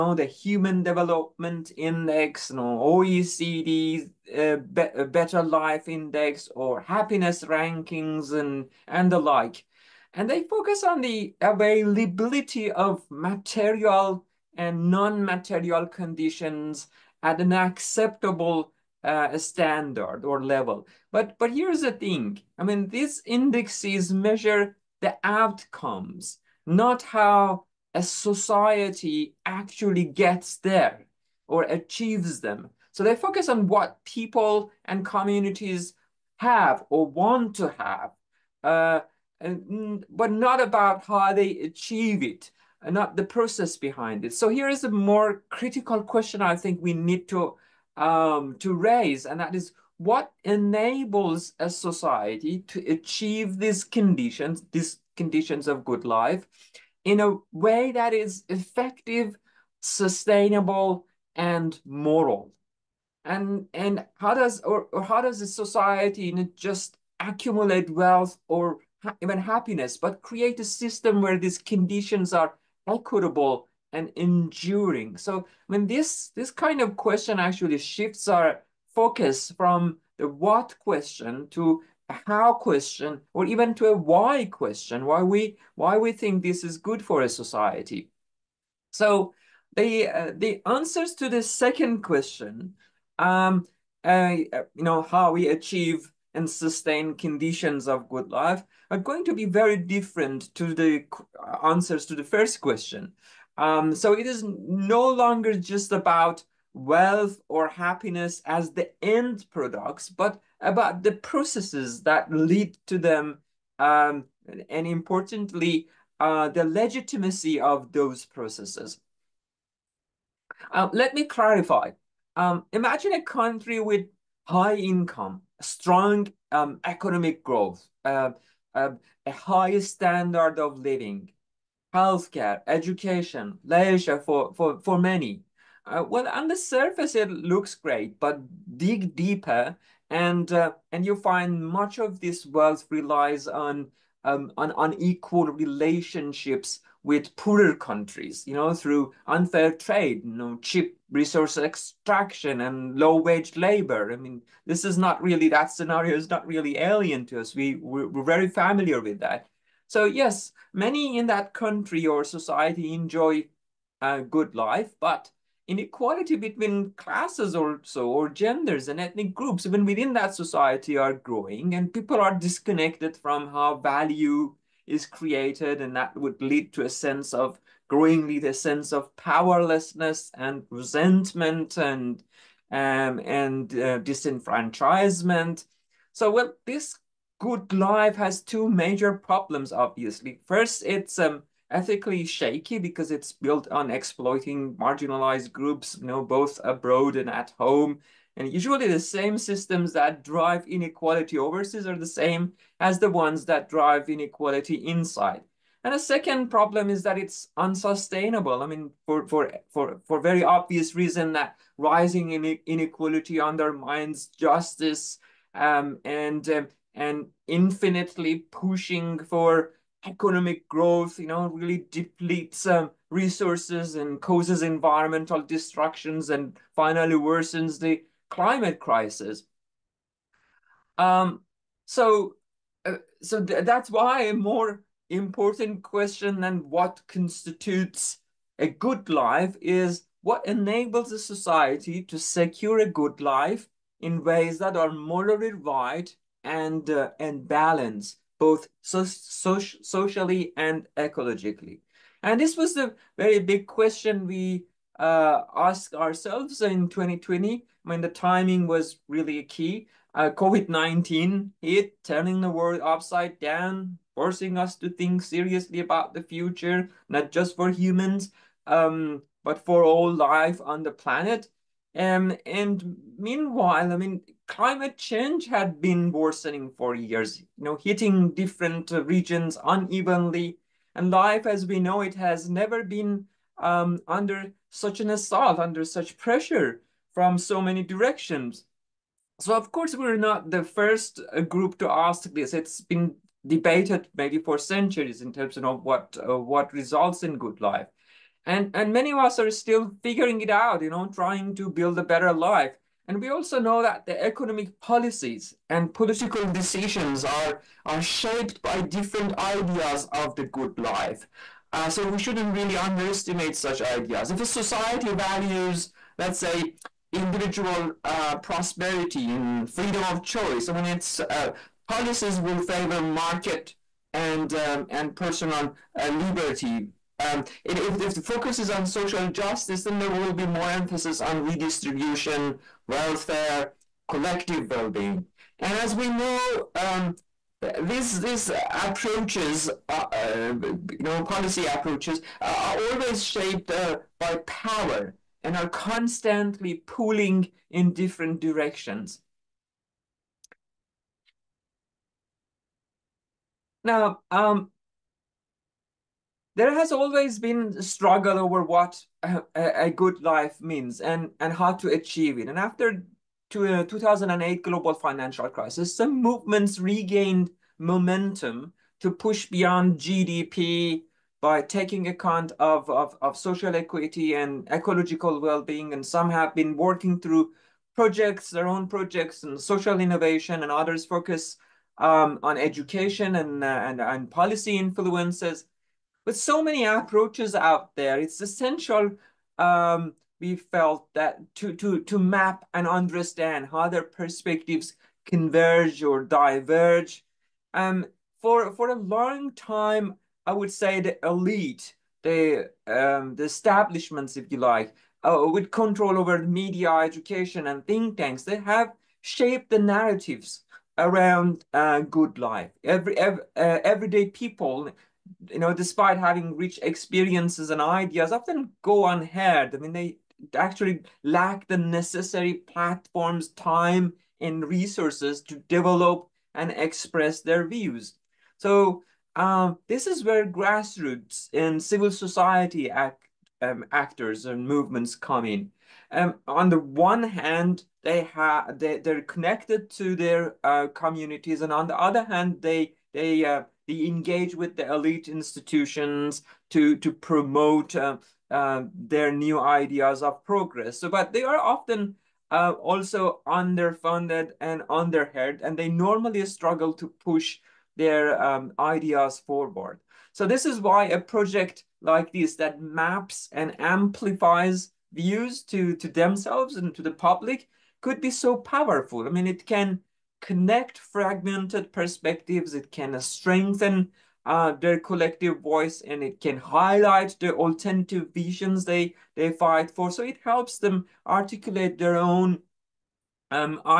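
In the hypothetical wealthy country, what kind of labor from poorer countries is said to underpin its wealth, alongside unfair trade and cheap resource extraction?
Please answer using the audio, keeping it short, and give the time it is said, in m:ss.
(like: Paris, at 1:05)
Low wage labor, at 2:32.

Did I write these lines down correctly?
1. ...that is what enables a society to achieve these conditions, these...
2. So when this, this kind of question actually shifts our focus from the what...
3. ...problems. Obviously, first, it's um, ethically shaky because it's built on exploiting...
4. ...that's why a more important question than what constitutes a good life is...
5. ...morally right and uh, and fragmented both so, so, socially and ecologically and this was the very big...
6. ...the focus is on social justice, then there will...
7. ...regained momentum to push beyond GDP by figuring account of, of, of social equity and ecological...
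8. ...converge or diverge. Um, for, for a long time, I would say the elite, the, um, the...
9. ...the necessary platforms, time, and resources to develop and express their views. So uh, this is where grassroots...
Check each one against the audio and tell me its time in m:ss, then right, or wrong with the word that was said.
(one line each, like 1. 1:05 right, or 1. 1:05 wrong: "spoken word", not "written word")
1. 0:49 right
2. 1:15 right
3. 3:09 right
4. 3:53 right
5. 4:04 wrong: "balanced", not "fragmented"
6. 5:28 right
7. 6:06 wrong: "taking", not "figuring"
8. 6:35 right
9. 7:01 right.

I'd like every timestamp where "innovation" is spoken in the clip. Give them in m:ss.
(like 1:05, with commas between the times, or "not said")
6:19.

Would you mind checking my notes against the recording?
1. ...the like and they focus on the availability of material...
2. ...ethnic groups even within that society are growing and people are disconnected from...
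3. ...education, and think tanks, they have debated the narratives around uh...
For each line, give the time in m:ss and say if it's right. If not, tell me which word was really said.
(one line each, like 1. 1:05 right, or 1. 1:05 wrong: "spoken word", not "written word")
1. 0:09 right
2. 2:48 right
3. 6:46 wrong: "shaped", not "debated".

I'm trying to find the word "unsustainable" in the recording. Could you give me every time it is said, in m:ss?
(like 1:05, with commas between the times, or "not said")
3:27.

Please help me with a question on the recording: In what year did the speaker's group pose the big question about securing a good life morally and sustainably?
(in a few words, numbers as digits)
2020.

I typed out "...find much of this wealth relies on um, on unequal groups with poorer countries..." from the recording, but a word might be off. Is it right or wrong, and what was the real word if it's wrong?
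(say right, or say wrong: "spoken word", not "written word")
wrong: "relationships", not "groups".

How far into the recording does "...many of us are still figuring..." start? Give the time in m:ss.
4:58.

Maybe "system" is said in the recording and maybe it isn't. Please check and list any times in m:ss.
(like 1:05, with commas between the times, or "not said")
1:10, 3:19.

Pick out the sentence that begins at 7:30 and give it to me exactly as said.
So, but they are often uh, also underfunded and underheard, and they normally struggle to push their um, ideas forward.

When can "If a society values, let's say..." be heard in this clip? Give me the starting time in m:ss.
5:14.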